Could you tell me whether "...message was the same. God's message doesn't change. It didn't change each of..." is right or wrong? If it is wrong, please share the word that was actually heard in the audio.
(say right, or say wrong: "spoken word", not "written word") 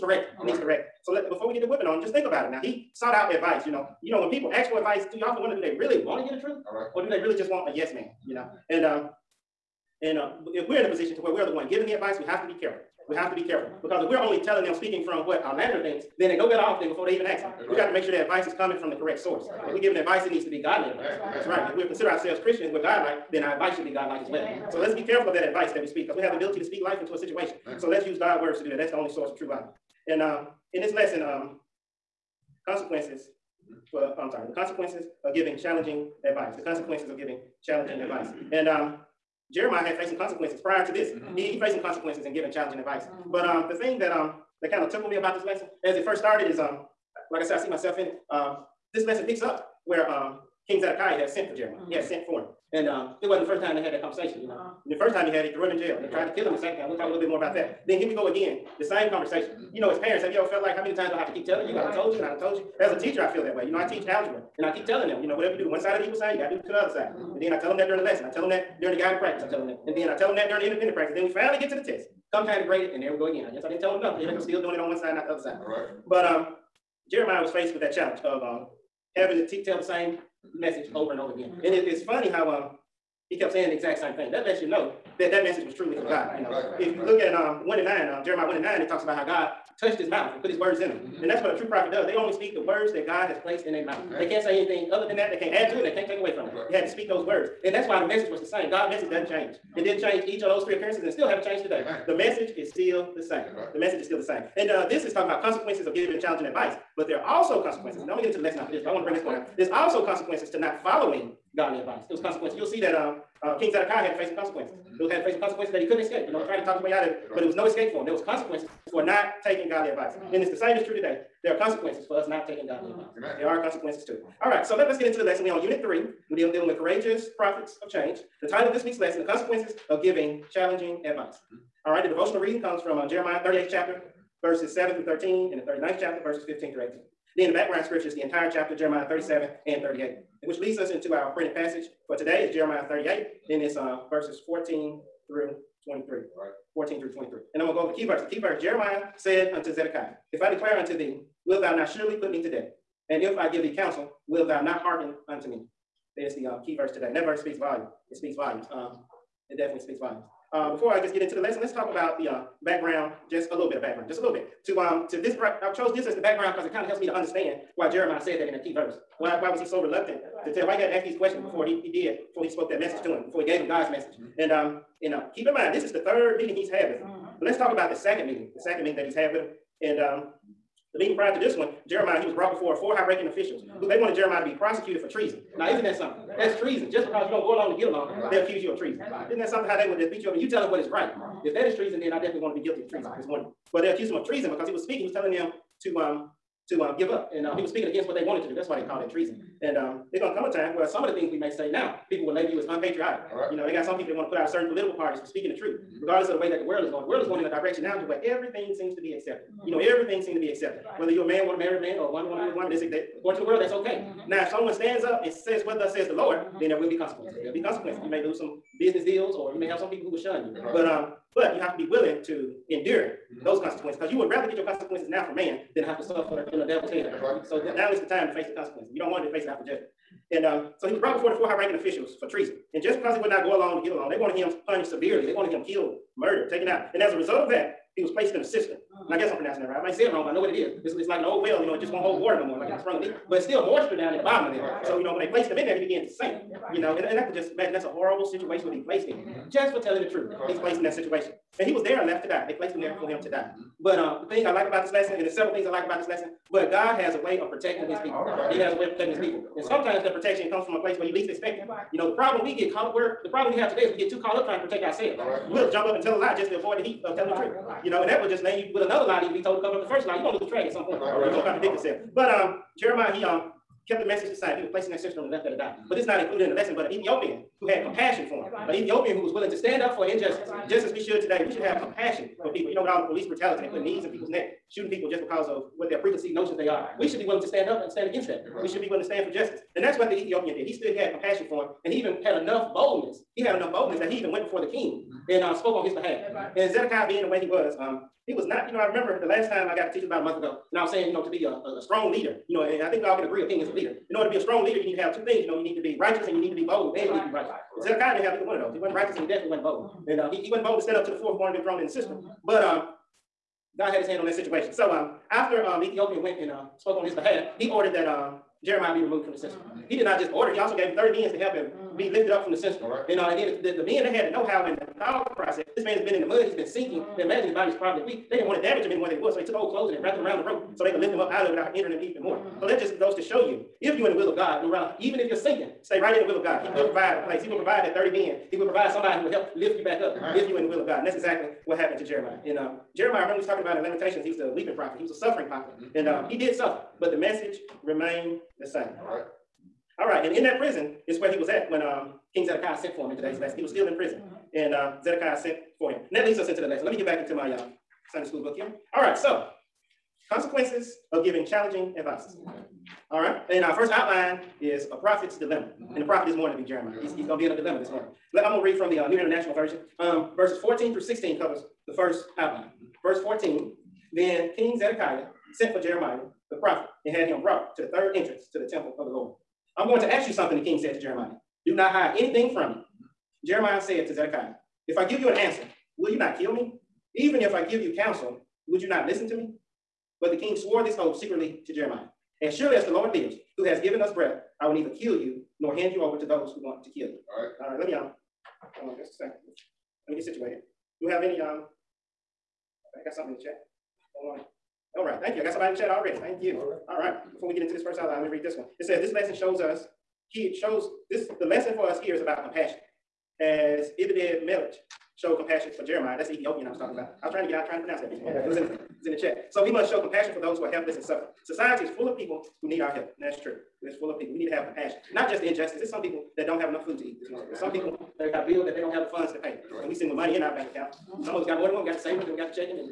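right.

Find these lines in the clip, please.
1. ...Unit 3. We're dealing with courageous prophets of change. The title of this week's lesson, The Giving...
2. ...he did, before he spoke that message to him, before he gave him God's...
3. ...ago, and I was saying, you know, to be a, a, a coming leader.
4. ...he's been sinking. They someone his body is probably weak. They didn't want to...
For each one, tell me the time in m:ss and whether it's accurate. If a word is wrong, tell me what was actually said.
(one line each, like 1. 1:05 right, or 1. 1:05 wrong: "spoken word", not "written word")
1. 2:05 wrong: "Consequences", not "Giving"
2. 2:51 right
3. 5:00 wrong: "strong", not "coming"
4. 5:26 wrong: "imagine", not "someone".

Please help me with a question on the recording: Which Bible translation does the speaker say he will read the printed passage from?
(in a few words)
New International Version.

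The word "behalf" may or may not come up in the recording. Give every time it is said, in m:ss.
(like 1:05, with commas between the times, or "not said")
4:55, 5:17.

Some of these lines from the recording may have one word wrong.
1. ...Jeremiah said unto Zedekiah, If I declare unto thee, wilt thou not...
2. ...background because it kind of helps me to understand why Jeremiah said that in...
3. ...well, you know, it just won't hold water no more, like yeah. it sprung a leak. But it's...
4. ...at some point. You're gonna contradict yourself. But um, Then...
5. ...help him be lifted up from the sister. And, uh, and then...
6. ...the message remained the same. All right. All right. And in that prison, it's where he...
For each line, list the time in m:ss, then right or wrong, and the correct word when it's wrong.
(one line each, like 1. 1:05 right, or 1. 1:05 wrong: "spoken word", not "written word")
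1. 2:28 right
2. 2:46 right
3. 4:01 right
4. 4:30 wrong: "Jeremiah", not "Then"
5. 5:21 right
6. 5:47 right.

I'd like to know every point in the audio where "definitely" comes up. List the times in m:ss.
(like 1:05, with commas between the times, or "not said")
2:39, 3:12, 5:09.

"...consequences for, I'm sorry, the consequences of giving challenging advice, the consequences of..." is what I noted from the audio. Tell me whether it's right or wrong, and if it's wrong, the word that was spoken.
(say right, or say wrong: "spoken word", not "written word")
right.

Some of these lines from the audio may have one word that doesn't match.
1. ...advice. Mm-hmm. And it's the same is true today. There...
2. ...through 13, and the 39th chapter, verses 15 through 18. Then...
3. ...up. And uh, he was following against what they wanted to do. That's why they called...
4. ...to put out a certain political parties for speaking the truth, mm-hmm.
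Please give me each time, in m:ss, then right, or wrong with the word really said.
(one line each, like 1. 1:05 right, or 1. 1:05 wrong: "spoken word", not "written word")
1. 1:59 right
2. 2:14 right
3. 3:17 wrong: "speaking", not "following"
4. 3:24 right.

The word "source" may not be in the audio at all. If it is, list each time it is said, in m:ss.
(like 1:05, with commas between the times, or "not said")
0:19, 0:29.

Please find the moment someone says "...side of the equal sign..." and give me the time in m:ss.
1:05.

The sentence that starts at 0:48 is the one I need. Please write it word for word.
Um, this lesson picks up where um, King Zedekiah had sent for Jeremiah.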